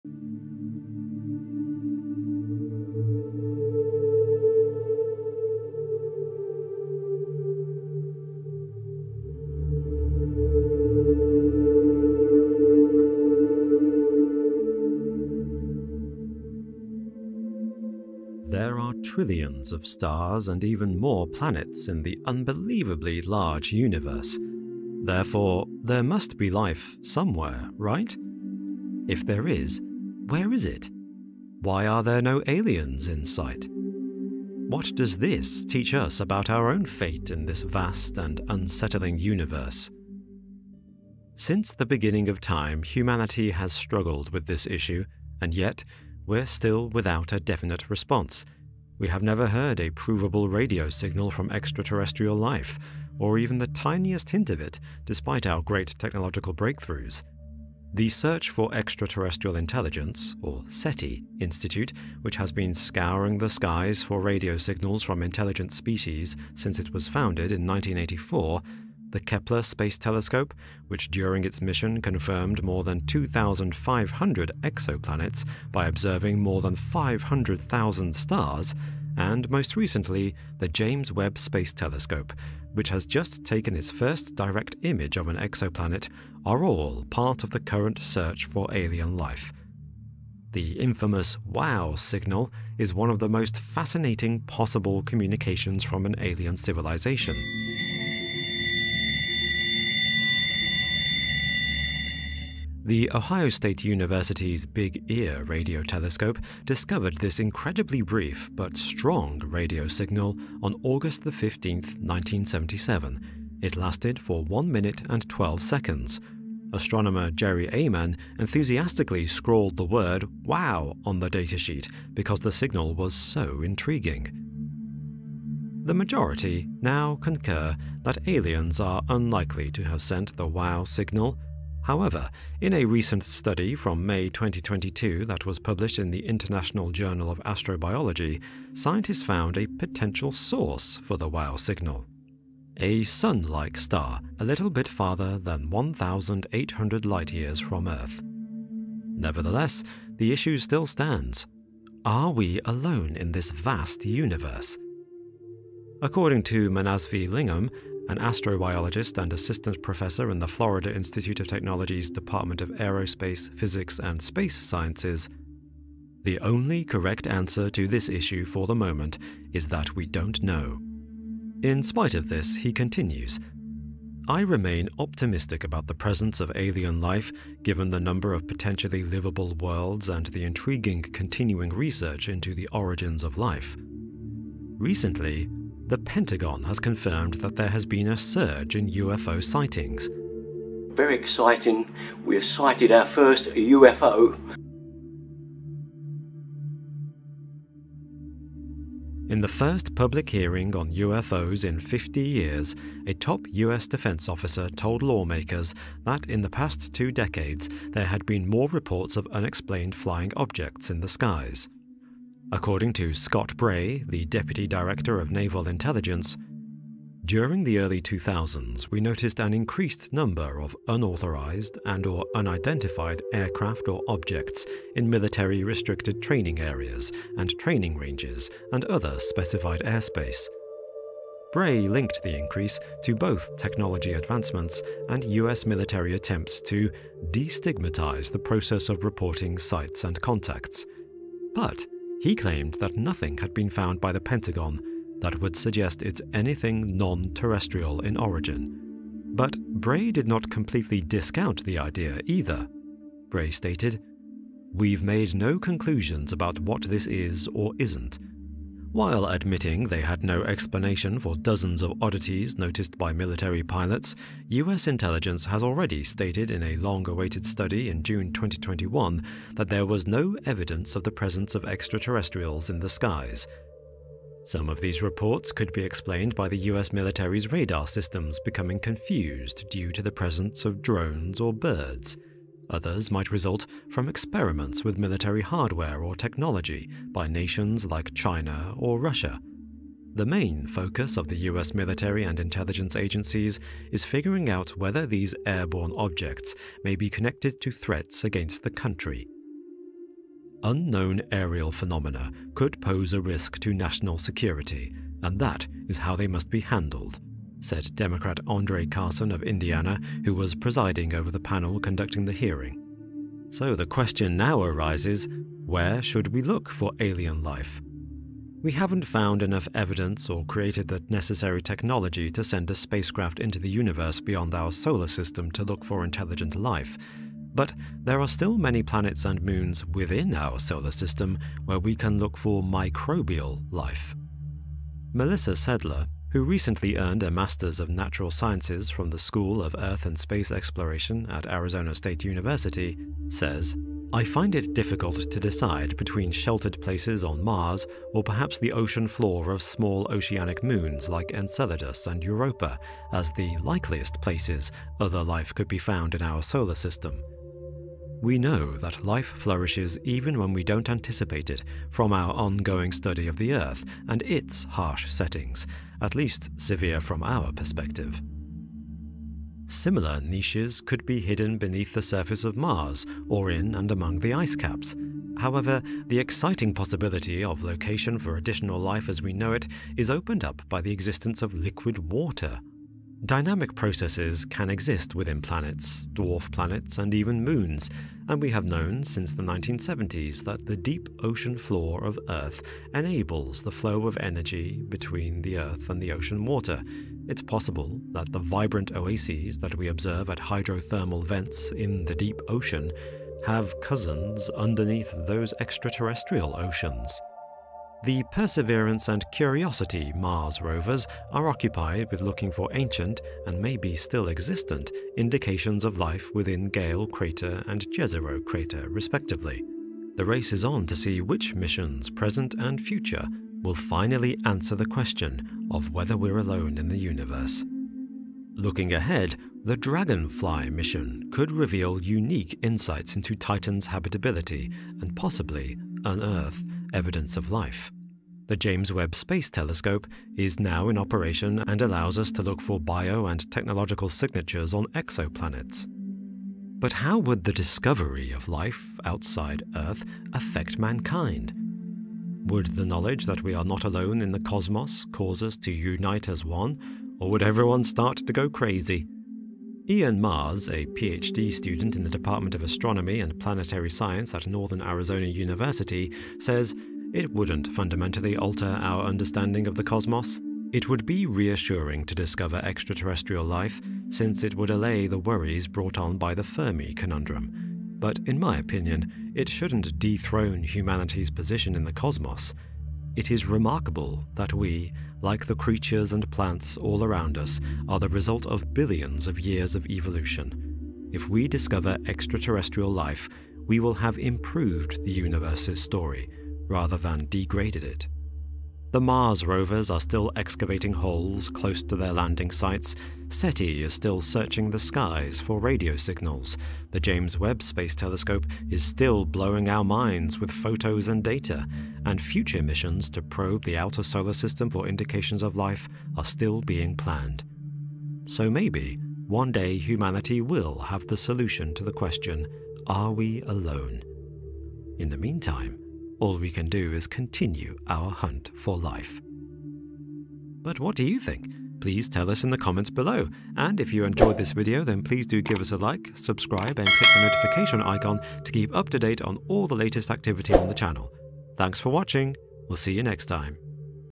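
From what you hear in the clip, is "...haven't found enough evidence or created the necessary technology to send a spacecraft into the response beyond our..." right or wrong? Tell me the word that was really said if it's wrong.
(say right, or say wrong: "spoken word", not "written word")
wrong: "universe", not "response".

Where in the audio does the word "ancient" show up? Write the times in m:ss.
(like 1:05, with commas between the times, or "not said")
6:52.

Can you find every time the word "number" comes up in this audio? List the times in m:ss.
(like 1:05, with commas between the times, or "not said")
2:58, 3:40.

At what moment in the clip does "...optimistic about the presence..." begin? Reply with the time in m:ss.
2:54.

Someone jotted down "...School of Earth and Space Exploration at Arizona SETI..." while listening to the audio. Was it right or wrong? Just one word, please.
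wrong.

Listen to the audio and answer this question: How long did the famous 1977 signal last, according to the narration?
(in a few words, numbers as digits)
1 minute and 12 seconds.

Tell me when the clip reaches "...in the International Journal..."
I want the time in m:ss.
2:15.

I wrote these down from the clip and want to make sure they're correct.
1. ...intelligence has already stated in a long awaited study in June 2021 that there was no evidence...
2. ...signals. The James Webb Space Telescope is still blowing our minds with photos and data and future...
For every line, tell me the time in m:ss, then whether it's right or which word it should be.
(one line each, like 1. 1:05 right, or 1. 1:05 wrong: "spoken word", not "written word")
1. 4:24 right
2. 8:25 right.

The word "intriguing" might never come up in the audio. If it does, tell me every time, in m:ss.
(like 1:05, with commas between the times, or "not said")
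2:03, 3:00.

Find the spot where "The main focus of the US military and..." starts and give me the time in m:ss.
4:50.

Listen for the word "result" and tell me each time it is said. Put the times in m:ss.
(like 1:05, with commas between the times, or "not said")
4:43, 8:08.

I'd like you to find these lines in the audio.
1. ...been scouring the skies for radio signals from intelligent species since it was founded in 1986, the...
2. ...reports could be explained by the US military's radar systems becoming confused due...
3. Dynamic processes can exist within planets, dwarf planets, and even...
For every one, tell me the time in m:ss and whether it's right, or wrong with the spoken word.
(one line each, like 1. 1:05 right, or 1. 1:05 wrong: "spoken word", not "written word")
1. 1:02 wrong: "1984", not "1986"
2. 4:35 right
3. 6:23 right.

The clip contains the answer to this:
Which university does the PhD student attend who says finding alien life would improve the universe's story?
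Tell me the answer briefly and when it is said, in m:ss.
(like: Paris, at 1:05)
Northern Arizona University, at 7:44.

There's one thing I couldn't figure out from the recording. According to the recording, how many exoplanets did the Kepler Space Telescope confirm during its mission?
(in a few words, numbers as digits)
more than 2,500.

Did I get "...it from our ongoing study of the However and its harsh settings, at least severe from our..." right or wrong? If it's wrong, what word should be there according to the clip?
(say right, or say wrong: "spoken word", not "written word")
wrong: "Earth", not "However".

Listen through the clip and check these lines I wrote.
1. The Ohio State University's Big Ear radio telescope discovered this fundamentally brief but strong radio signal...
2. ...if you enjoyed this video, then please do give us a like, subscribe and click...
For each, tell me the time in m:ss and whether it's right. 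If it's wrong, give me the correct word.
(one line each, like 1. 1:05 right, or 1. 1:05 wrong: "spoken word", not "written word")
1. 1:42 wrong: "incredibly", not "fundamentally"
2. 8:53 right.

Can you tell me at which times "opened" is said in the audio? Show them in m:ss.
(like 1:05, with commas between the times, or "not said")
6:20.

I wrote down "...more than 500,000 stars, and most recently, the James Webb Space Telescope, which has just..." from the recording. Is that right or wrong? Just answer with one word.
right.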